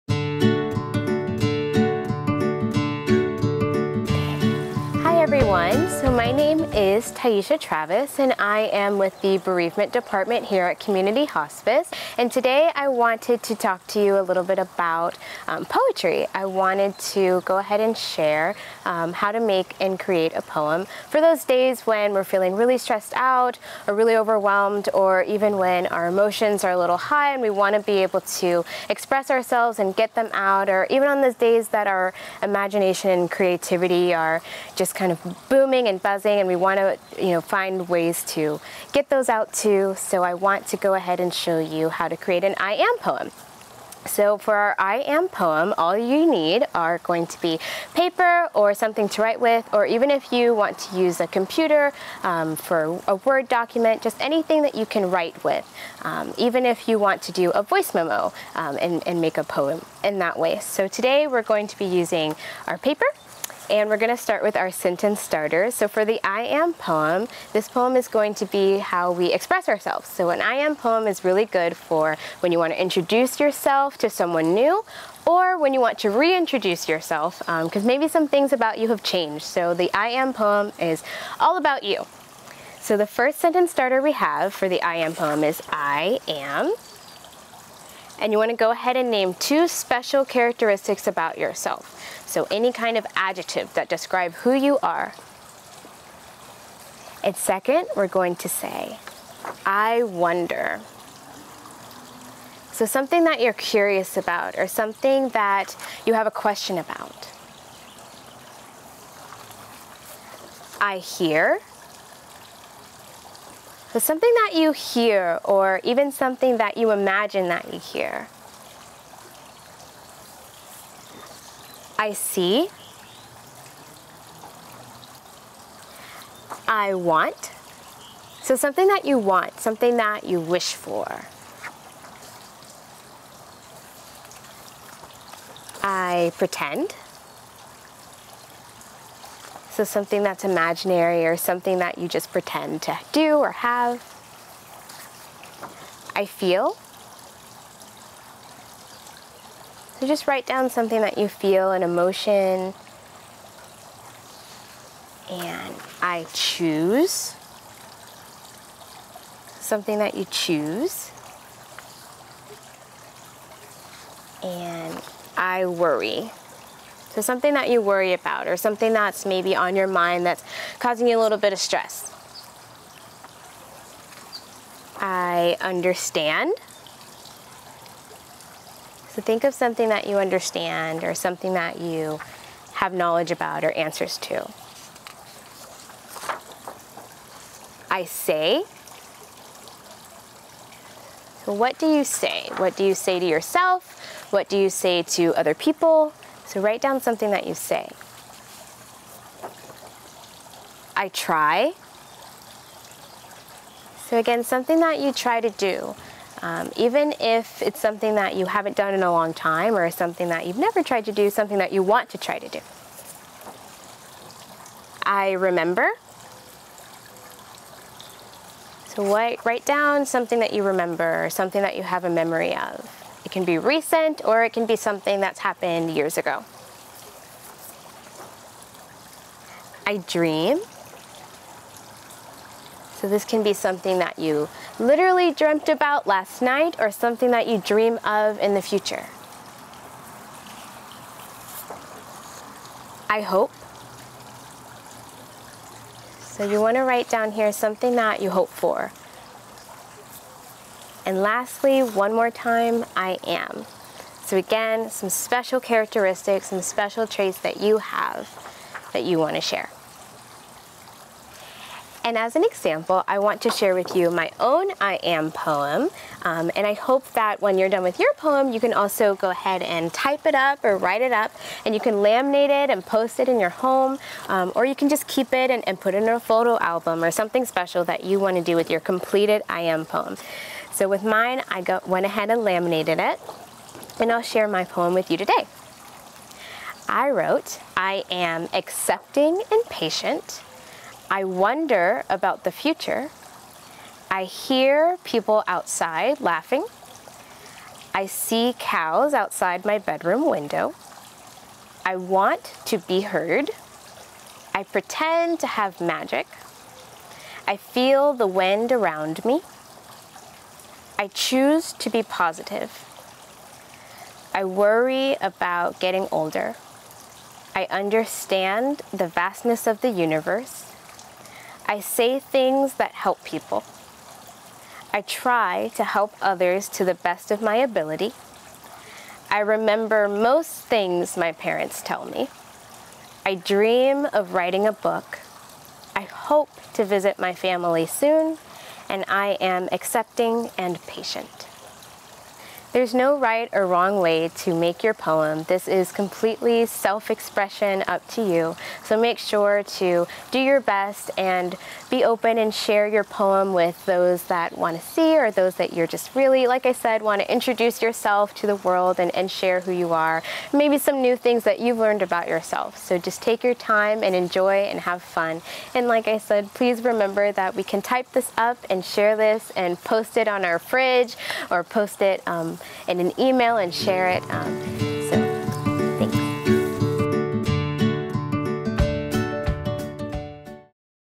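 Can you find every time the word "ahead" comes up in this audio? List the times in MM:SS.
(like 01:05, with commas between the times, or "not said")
00:17, 00:40, 01:28, 04:29, 04:42.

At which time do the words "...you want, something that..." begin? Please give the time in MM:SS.
02:09.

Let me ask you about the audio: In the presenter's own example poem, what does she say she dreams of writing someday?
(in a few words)
a book.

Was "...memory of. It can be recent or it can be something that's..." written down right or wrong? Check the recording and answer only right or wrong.
right.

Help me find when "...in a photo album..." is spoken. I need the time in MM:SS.
04:36.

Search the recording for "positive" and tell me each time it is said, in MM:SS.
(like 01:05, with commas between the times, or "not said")
05:12.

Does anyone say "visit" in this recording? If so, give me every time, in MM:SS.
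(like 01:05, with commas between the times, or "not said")
05:36.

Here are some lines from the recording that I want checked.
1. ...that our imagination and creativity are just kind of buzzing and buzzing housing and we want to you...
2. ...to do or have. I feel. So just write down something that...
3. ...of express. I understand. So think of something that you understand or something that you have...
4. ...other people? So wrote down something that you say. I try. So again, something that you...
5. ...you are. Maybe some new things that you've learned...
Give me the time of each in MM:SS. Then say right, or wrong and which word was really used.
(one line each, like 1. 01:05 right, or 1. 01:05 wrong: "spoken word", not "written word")
1. 00:31 wrong: "booming", not "buzzing"
2. 02:22 right
3. 02:51 wrong: "stress", not "express"
4. 03:15 wrong: "write", not "wrote"
5. 05:59 right.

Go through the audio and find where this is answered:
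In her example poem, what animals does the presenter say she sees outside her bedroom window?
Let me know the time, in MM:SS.
04:58.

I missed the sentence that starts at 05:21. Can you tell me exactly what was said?
I say things that help people.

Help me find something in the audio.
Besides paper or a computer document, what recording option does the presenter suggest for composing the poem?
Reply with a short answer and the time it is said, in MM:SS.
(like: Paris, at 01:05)
voice memo, at 00:57.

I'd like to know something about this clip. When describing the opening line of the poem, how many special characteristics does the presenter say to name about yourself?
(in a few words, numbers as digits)
2.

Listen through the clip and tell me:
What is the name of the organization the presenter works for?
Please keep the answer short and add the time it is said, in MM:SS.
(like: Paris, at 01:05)
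Community Hospice, at 00:10.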